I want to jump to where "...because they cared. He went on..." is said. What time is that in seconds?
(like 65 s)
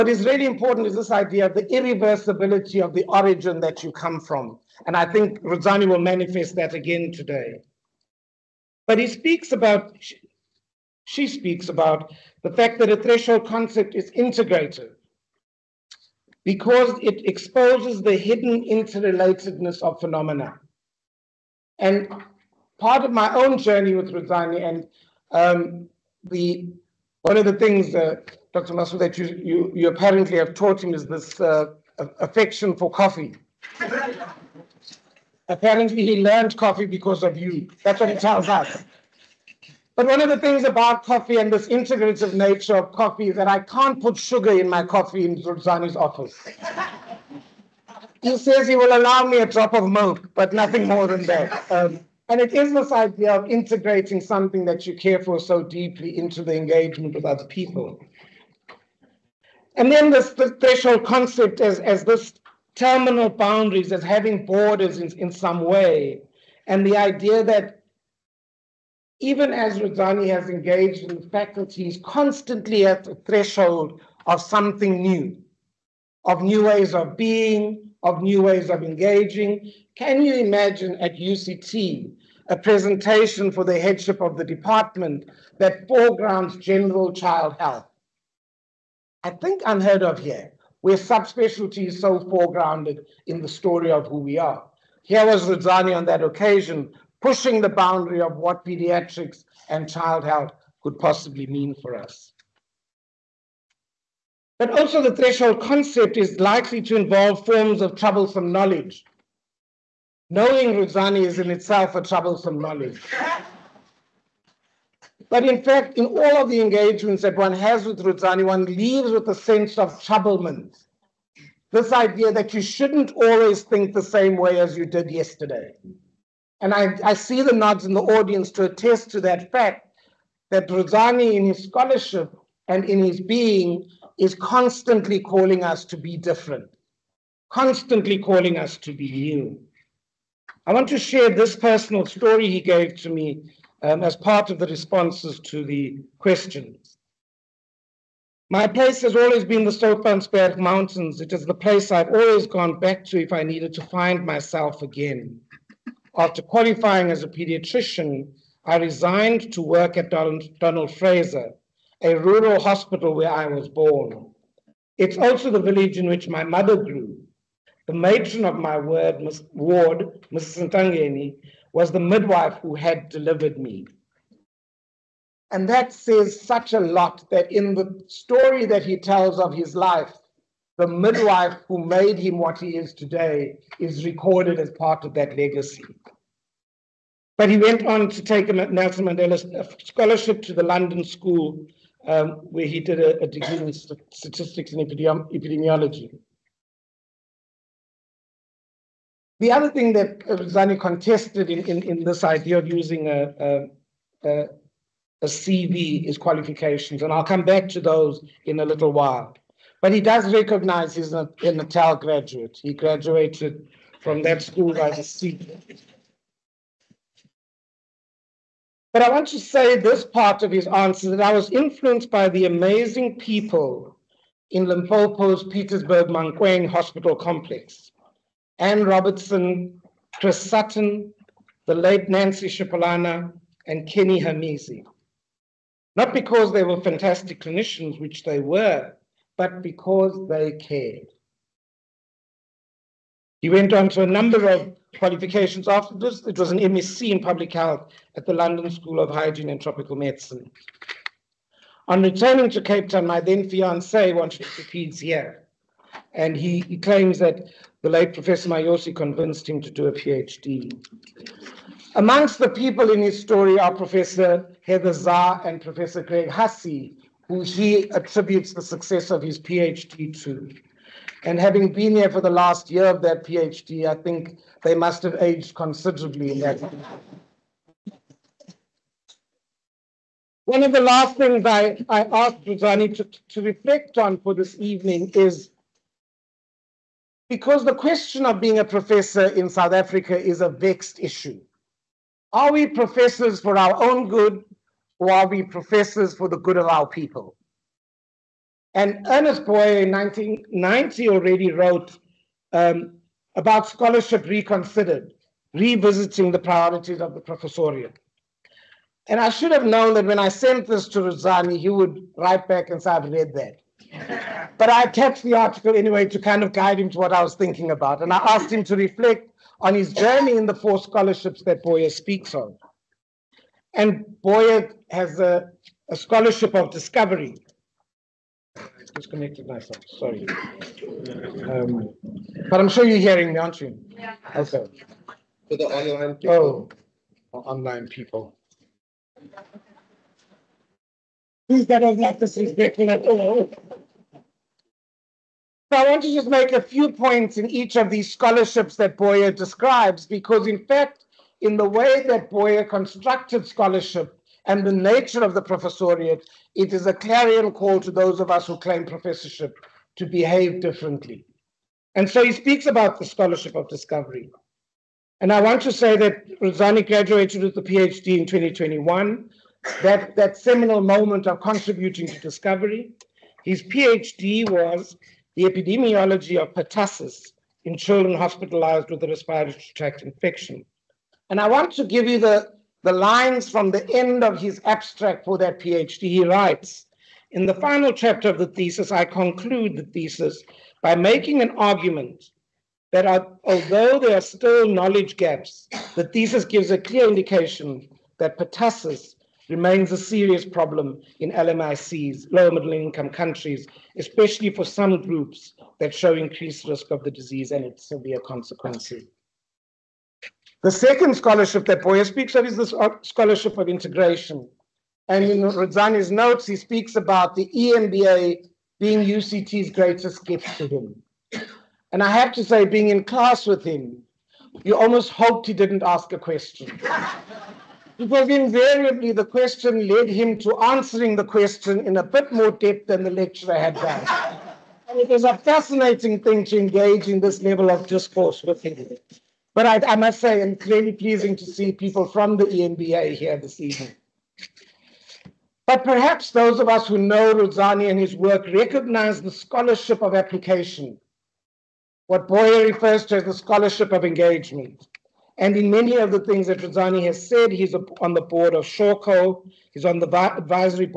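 239 s.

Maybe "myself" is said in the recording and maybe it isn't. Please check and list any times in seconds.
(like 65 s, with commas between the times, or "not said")
154 s, 329 s.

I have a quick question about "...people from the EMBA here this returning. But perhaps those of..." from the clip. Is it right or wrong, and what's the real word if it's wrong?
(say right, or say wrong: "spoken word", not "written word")
wrong: "evening", not "returning".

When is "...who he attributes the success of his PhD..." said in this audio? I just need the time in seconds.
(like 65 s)
267 s.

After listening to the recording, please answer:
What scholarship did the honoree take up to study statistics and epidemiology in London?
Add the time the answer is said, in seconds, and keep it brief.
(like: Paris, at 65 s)
Nelson Mandela scholarship, at 188 s.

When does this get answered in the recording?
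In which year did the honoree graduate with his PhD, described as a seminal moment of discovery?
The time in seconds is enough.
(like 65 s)
368 s.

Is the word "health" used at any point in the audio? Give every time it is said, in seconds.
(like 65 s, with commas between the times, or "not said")
87 s, 100 s, 247 s.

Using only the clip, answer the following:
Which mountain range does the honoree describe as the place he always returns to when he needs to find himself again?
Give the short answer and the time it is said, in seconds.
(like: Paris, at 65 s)
Soutpansberg Mountains, at 149 s.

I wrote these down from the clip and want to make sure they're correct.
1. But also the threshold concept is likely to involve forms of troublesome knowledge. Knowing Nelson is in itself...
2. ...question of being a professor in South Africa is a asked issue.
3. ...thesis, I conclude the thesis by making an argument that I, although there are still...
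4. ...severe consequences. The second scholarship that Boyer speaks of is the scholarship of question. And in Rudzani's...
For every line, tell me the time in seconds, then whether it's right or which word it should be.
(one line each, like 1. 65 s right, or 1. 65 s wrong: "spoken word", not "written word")
1. 104 s wrong: "Rudzani", not "Nelson"
2. 287 s wrong: "vexed", not "asked"
3. 388 s right
4. 407 s wrong: "integration", not "question".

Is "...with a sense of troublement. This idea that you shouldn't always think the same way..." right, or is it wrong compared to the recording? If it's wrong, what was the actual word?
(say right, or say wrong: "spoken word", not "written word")
right.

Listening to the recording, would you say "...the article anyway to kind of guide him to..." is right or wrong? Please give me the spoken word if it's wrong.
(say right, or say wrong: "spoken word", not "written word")
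right.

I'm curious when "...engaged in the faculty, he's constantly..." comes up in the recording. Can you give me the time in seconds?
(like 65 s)
70 s.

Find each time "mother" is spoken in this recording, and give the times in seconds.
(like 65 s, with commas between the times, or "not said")
166 s.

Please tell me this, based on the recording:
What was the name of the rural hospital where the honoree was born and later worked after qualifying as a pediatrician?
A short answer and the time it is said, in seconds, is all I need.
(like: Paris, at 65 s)
Donald Fraser, at 160 s.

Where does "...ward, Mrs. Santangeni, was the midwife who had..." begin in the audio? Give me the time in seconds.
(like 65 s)
169 s.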